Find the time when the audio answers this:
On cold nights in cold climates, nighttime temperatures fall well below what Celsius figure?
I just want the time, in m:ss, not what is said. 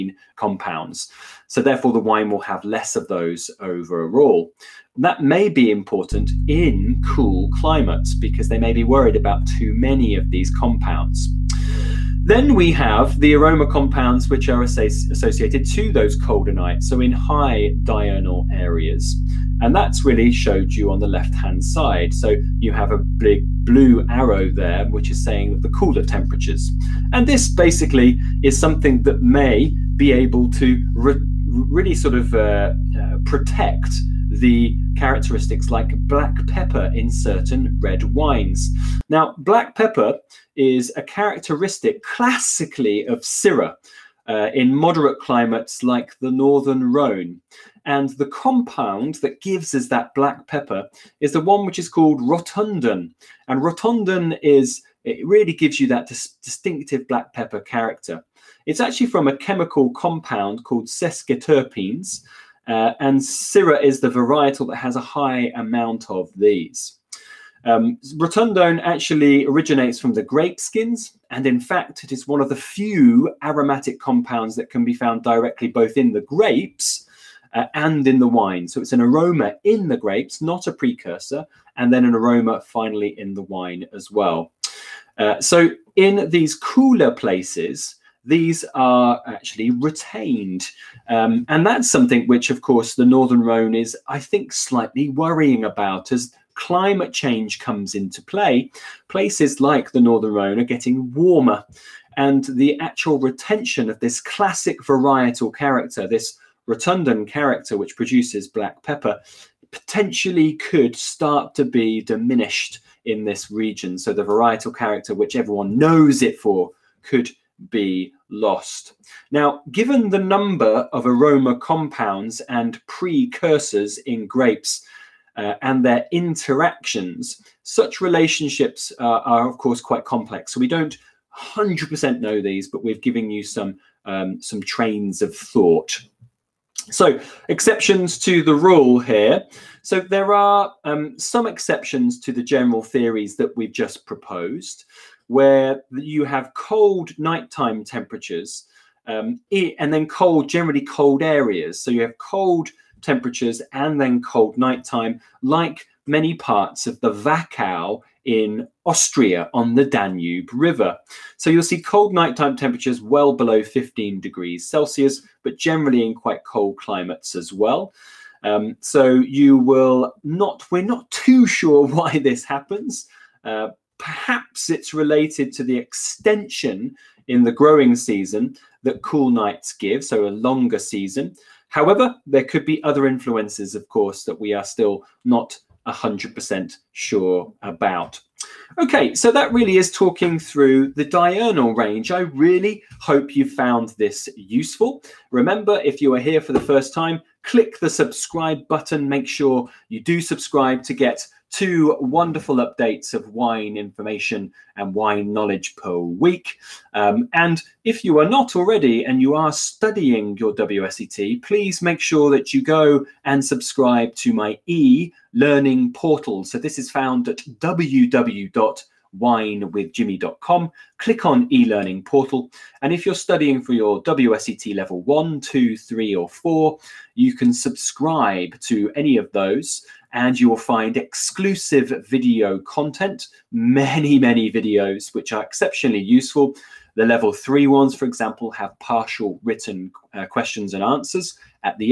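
2:43.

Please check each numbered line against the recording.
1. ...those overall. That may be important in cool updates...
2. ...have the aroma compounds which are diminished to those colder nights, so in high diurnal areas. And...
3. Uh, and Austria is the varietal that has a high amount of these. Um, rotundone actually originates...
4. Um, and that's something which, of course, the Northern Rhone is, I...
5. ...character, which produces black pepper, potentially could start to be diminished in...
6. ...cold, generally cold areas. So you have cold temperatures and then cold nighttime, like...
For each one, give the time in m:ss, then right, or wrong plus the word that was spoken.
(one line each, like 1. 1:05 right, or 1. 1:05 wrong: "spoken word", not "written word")
1. 0:03 wrong: "climates", not "updates"
2. 0:12 wrong: "associated", not "diminished"
3. 1:02 wrong: "Syrah", not "Austria"
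4. 1:31 right
5. 1:47 right
6. 2:30 right.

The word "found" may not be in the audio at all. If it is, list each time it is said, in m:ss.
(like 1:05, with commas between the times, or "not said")
1:14, 3:13, 3:36.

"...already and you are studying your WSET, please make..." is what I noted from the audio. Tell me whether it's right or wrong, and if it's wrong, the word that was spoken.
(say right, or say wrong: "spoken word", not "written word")
right.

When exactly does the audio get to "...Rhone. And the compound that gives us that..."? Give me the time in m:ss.
0:46.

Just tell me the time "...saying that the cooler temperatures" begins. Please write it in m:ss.
0:25.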